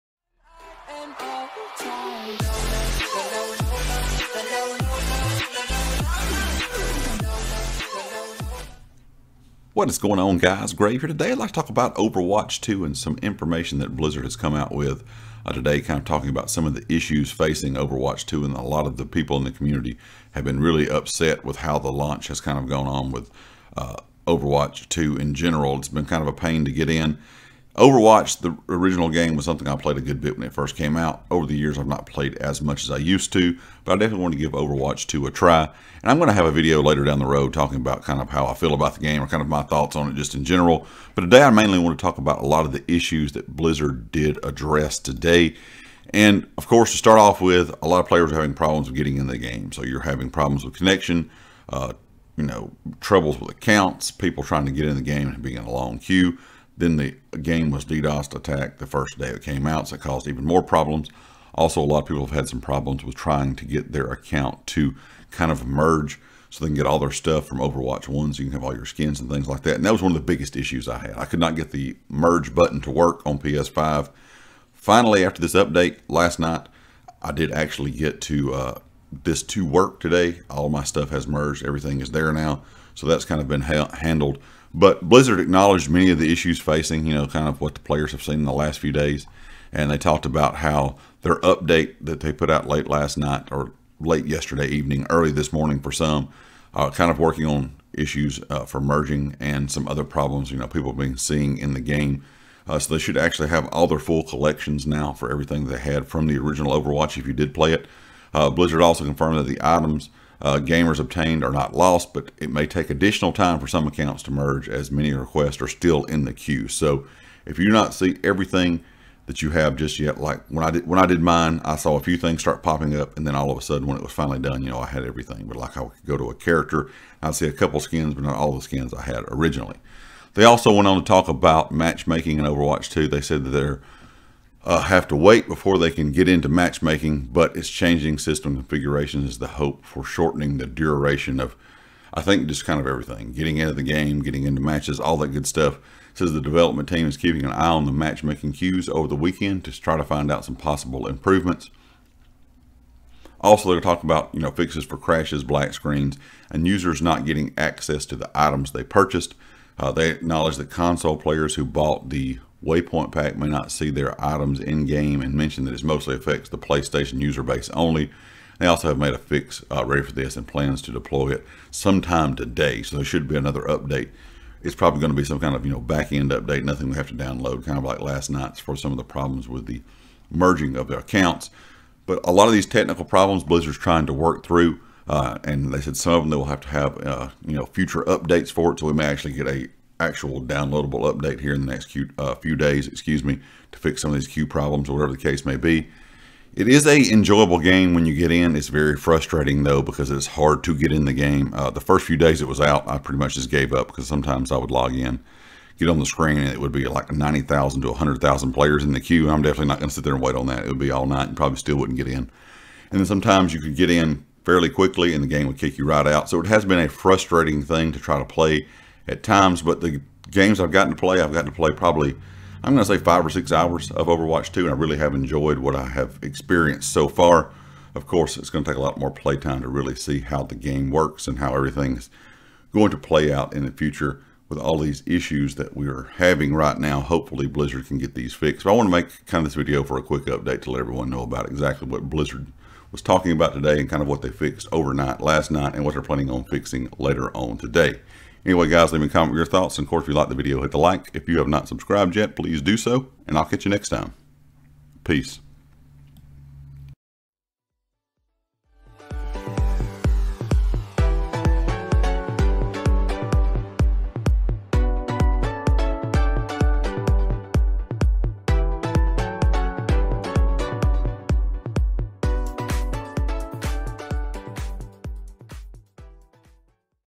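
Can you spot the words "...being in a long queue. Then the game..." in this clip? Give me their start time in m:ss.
0:55.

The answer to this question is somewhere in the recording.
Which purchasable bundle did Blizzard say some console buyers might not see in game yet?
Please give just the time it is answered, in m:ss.
2:42.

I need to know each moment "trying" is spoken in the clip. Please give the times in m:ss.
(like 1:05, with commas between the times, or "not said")
0:54, 1:03, 3:03.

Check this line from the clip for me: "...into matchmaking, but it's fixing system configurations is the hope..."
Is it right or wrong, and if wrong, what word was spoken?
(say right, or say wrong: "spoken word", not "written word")
wrong: "changing", not "fixing".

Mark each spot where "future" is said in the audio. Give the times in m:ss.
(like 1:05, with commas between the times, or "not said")
3:07, 3:53.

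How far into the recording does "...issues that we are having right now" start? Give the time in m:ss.
3:55.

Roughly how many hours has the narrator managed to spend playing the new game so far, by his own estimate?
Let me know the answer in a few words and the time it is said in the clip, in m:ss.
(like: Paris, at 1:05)
5 or 6 hours, at 3:43.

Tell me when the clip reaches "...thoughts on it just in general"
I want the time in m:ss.
0:39.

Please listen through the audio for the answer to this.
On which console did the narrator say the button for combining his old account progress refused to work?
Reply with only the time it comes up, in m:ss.
1:13.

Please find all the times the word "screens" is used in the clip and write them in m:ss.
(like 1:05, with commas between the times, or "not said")
2:35, 3:26.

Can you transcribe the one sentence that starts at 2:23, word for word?
Getting into the game, getting into matches, all that good stuff.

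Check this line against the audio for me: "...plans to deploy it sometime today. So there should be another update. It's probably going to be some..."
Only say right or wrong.
right.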